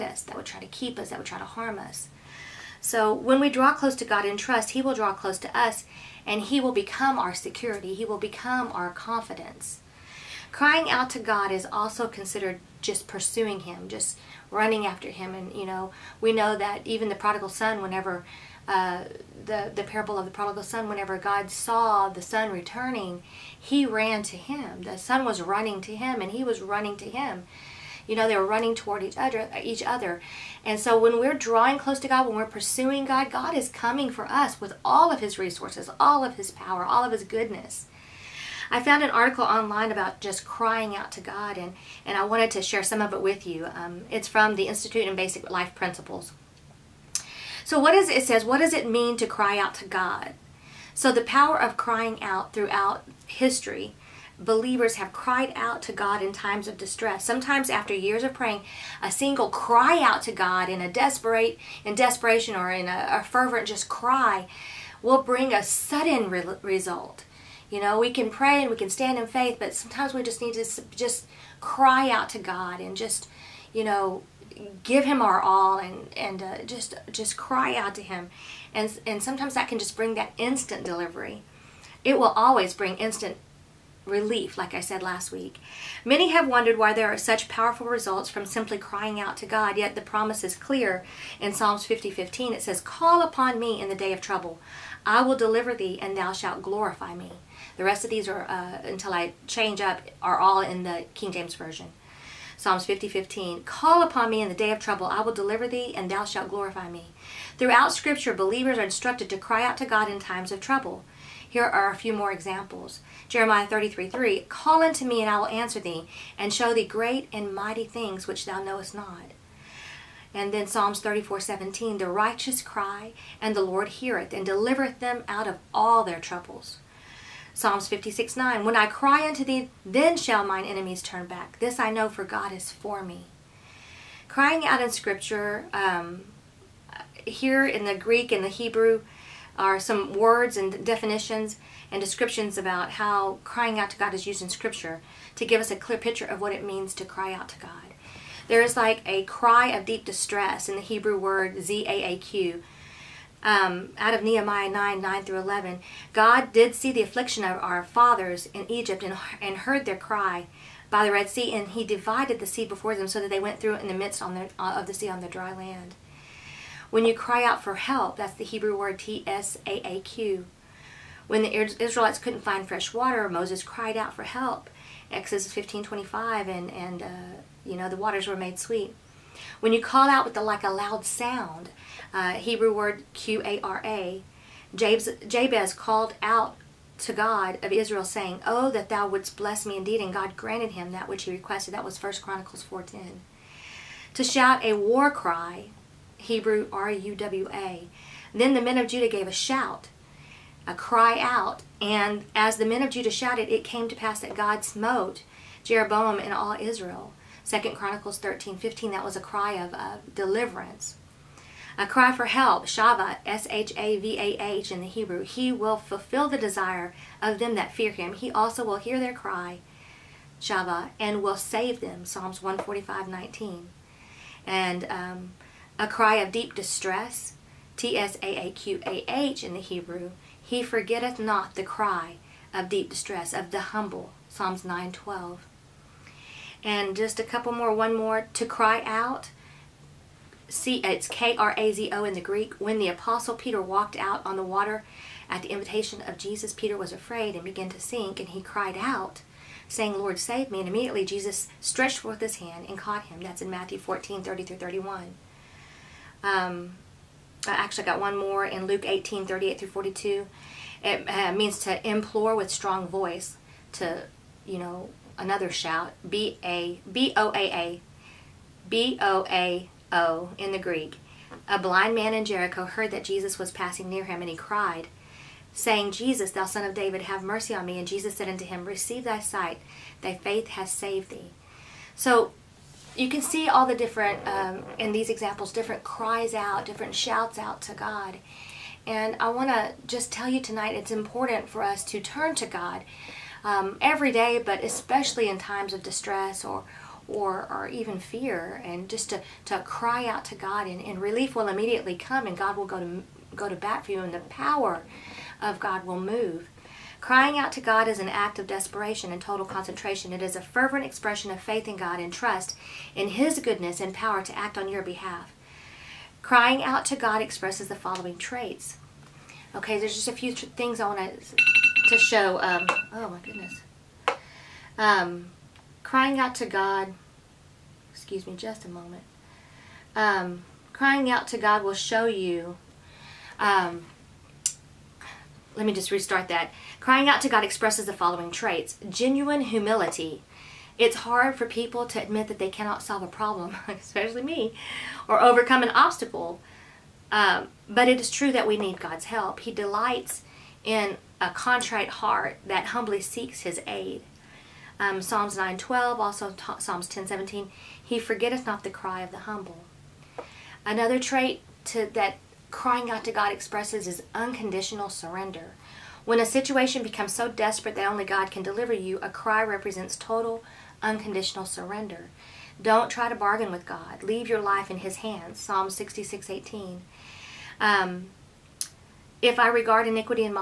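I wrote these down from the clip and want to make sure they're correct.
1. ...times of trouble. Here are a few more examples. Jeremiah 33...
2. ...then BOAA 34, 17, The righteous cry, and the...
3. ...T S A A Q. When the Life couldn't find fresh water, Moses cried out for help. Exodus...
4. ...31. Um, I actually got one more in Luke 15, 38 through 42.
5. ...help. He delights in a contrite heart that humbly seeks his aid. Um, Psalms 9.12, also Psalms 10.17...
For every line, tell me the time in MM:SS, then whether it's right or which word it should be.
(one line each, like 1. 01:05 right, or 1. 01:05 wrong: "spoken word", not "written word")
1. 01:50 right
2. 02:00 wrong: "Psalms", not "BOAA"
3. 02:48 wrong: "Israelites", not "Life"
4. 04:14 wrong: "18", not "15"
5. 05:49 right.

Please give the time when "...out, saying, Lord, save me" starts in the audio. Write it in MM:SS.
04:08.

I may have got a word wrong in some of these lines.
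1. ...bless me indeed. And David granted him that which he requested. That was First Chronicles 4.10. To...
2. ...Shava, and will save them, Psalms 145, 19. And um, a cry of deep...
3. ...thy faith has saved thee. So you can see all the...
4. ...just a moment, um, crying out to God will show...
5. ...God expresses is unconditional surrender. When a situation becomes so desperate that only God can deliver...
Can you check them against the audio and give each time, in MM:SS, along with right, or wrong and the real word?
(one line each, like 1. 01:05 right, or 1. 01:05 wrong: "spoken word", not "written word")
1. 03:09 wrong: "God", not "David"
2. 03:40 right
3. 04:40 right
4. 05:28 right
5. 06:03 right.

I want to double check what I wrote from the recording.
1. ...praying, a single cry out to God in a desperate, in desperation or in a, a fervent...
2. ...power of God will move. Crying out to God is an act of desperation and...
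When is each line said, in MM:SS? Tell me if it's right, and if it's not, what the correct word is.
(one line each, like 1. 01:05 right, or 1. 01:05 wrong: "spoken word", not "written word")
1. 00:58 right
2. 05:04 right.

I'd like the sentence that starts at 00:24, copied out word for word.
The son was running to him, and he was running to him.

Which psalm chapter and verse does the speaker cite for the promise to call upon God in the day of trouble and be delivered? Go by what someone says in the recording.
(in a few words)
Psalms 50:15.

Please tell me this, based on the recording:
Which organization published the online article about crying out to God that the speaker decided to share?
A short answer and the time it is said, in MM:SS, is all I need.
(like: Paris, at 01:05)
Institute in Basic Life Principles, at 00:44.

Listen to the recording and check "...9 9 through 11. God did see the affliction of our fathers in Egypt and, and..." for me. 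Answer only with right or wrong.
right.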